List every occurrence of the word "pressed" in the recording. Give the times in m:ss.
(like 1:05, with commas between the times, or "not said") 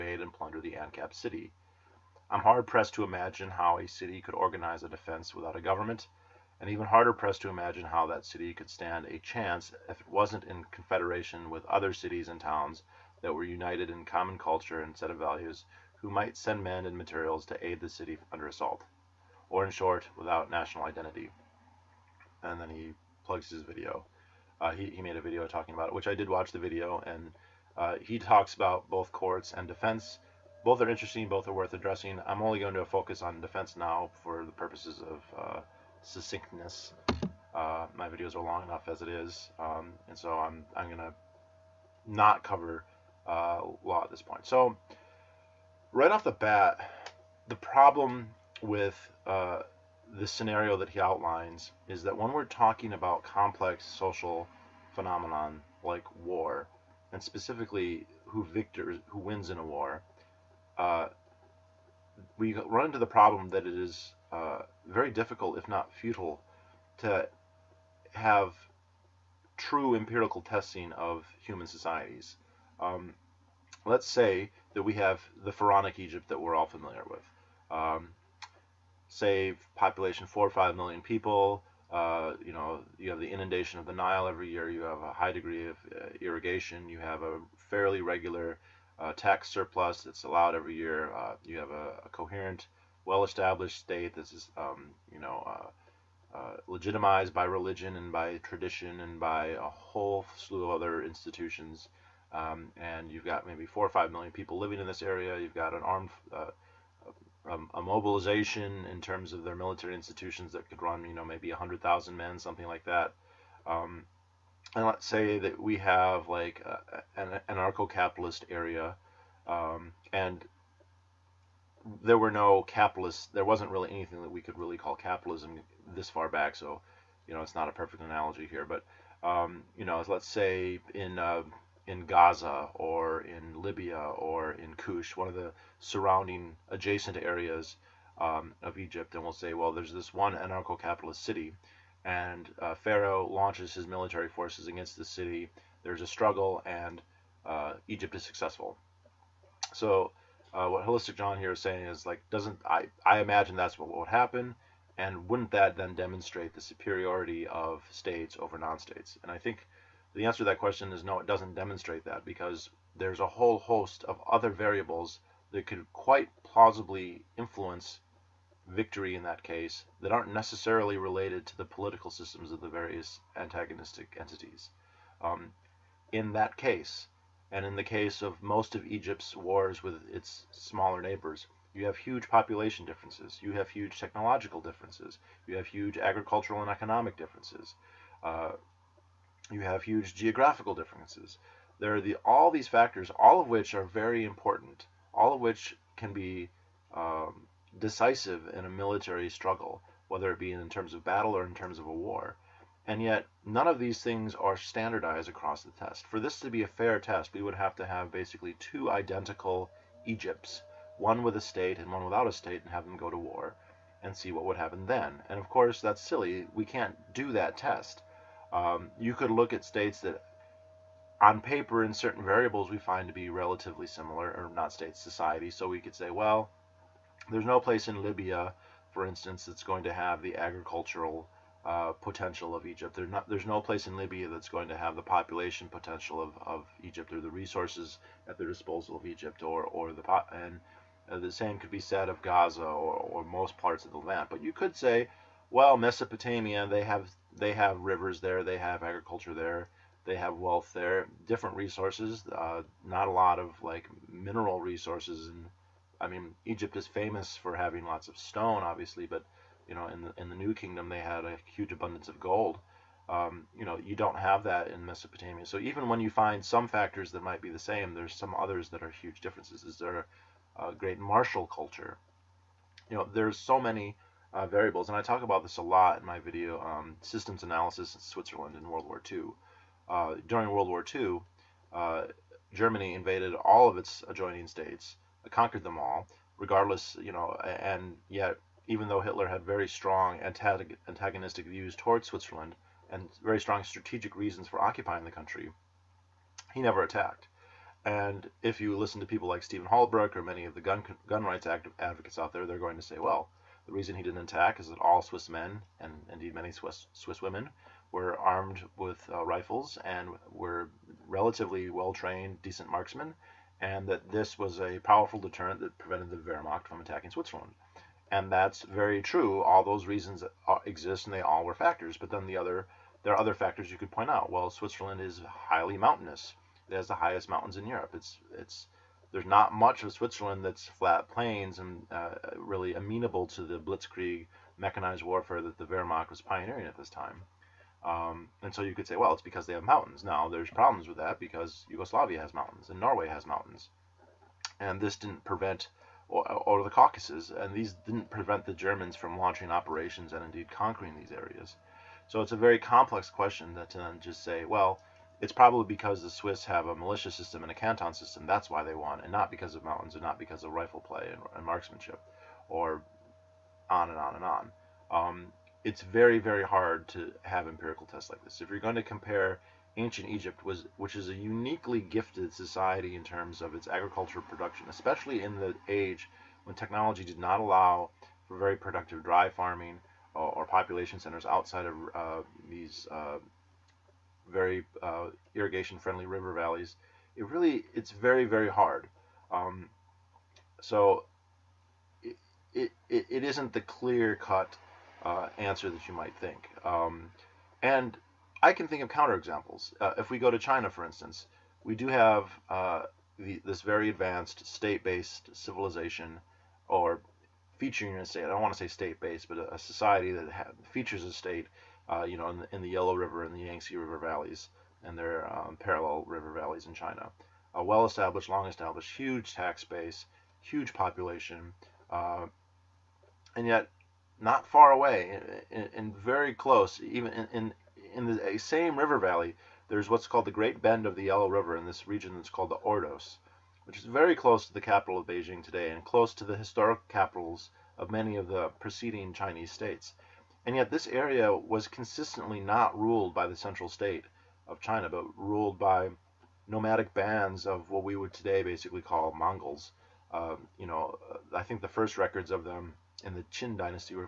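0:02, 0:07.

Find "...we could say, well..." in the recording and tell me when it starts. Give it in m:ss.
3:45.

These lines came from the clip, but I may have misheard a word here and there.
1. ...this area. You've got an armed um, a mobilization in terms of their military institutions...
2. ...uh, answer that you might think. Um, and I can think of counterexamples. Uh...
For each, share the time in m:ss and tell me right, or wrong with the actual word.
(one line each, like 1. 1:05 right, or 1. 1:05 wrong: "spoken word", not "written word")
1. 1:44 right
2. 6:35 right.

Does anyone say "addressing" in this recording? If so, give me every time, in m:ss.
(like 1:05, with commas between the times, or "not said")
0:31.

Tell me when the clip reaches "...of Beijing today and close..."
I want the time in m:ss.
7:14.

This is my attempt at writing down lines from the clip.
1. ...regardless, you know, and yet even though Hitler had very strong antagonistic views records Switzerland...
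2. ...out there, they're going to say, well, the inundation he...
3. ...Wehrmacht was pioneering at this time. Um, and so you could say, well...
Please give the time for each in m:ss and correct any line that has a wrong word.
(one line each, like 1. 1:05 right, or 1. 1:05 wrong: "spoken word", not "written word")
1. 4:46 wrong: "towards", not "records"
2. 5:02 wrong: "reason", not "inundation"
3. 5:35 right.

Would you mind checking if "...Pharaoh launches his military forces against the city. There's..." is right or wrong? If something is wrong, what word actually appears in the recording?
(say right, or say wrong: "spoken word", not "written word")
right.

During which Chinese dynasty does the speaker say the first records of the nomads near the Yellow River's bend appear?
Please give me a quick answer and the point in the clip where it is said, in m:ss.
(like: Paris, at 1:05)
Qin dynasty, at 7:33.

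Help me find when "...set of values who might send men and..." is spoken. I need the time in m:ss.
0:14.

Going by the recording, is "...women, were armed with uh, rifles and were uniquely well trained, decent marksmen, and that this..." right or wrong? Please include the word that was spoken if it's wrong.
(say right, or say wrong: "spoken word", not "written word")
wrong: "relatively", not "uniquely".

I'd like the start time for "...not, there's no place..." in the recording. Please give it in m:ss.
3:53.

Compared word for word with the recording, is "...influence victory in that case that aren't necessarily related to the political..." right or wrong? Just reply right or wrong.
right.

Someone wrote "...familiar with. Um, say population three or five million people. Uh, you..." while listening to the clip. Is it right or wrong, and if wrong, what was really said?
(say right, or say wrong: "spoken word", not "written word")
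wrong: "four", not "three".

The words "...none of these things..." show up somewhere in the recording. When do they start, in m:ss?
3:23.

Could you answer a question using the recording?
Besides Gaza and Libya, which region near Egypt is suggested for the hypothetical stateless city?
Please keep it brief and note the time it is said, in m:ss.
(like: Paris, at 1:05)
Kush, at 2:14.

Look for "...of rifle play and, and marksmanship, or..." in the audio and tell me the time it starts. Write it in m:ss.
6:00.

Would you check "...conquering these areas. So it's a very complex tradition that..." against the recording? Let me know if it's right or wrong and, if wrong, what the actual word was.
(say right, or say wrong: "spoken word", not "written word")
wrong: "question", not "tradition".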